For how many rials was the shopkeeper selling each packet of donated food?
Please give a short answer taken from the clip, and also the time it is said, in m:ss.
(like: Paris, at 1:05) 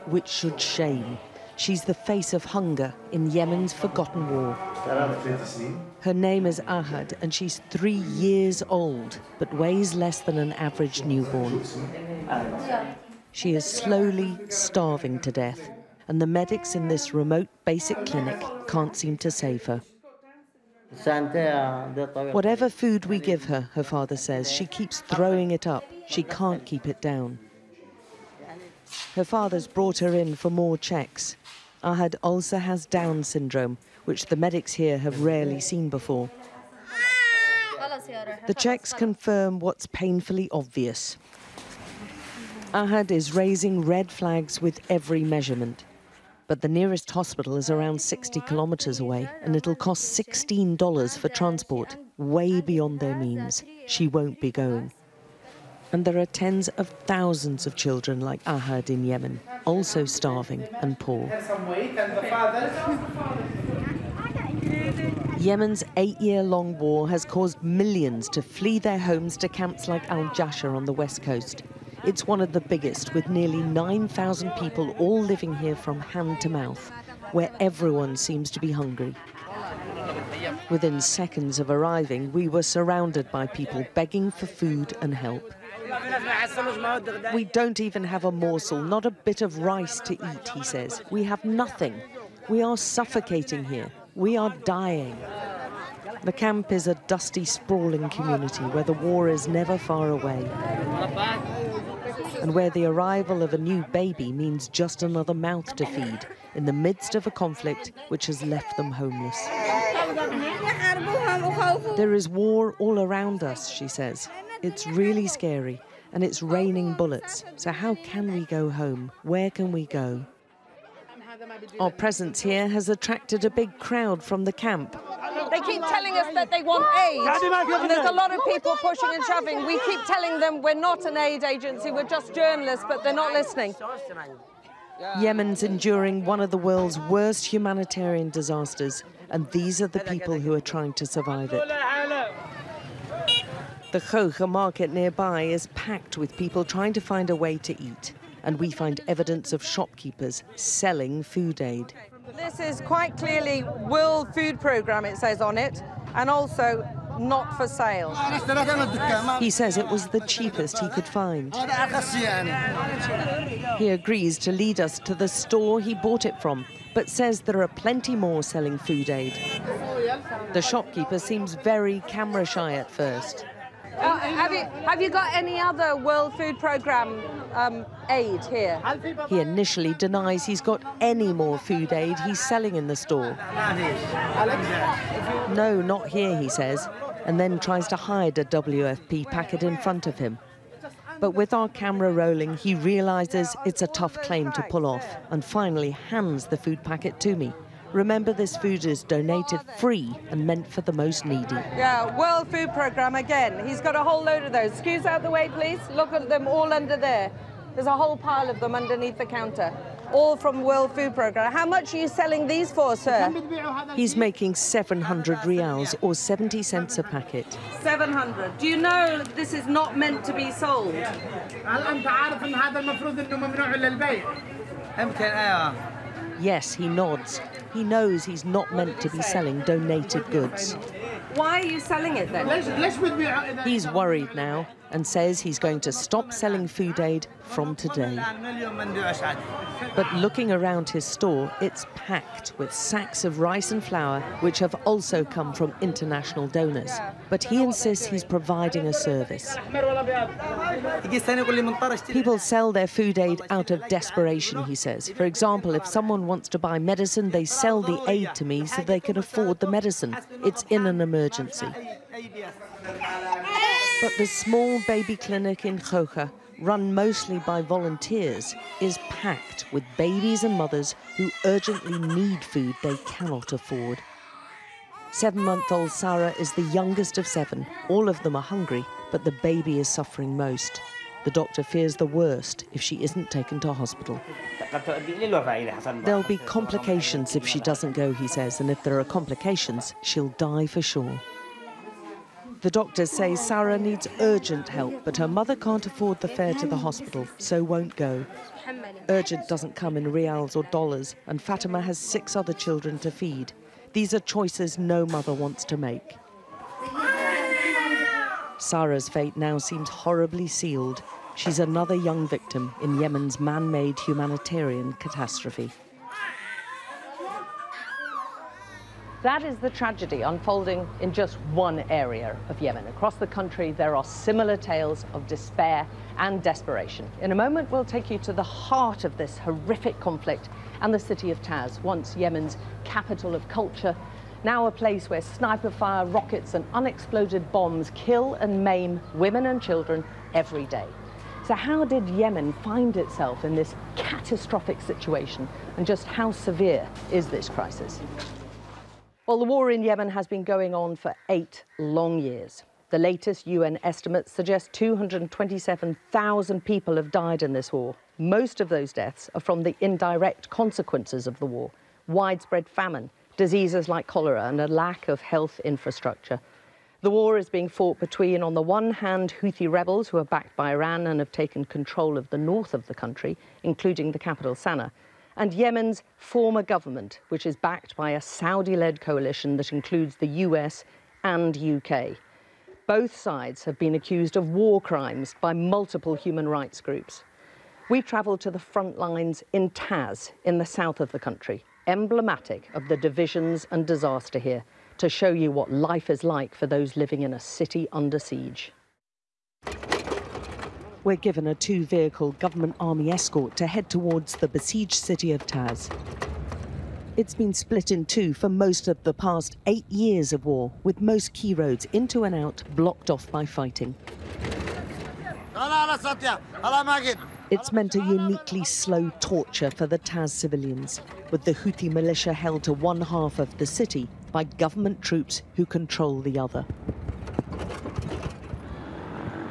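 700, at 3:34.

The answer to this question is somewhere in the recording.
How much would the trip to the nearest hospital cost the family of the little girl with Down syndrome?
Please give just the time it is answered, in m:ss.
0:50.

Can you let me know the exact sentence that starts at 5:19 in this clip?
That is the tragedy unfolding in just one area of Yemen.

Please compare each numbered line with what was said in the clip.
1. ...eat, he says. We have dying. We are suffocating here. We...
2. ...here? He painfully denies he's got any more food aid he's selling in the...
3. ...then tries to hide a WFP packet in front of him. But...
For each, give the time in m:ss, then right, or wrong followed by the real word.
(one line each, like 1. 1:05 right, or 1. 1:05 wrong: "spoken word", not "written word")
1. 1:30 wrong: "nothing", not "dying"
2. 2:58 wrong: "initially", not "painfully"
3. 3:07 right.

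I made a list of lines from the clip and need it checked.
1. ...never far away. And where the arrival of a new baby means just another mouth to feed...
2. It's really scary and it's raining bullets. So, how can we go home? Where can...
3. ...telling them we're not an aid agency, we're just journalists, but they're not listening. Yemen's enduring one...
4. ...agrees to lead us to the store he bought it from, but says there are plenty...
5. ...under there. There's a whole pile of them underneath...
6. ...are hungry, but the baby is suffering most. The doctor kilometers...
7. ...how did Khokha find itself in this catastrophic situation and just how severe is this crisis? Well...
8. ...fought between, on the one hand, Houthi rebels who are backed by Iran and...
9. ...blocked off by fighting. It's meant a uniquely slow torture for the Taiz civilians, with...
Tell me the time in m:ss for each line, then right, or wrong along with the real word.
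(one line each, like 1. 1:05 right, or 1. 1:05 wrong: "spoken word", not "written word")
1. 1:39 right
2. 1:54 right
3. 2:10 right
4. 2:43 right
5. 3:26 right
6. 4:38 wrong: "fears", not "kilometers"
7. 5:41 wrong: "Yemen", not "Khokha"
8. 6:07 right
9. 6:52 right.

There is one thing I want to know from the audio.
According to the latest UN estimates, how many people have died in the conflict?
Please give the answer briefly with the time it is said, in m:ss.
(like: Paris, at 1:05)
227,000, at 5:54.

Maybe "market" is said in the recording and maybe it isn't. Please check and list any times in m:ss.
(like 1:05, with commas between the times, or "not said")
2:24.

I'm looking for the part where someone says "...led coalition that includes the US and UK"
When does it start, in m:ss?
6:18.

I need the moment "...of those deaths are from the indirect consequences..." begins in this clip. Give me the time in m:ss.
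5:58.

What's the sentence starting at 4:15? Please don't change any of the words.
For example, if someone wants to buy medicine, they sell the aid to me so they can afford the medicine.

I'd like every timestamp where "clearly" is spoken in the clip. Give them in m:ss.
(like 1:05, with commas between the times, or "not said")
2:33.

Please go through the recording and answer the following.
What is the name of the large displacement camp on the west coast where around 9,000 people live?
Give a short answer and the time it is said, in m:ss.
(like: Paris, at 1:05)
Al Jasher, at 1:10.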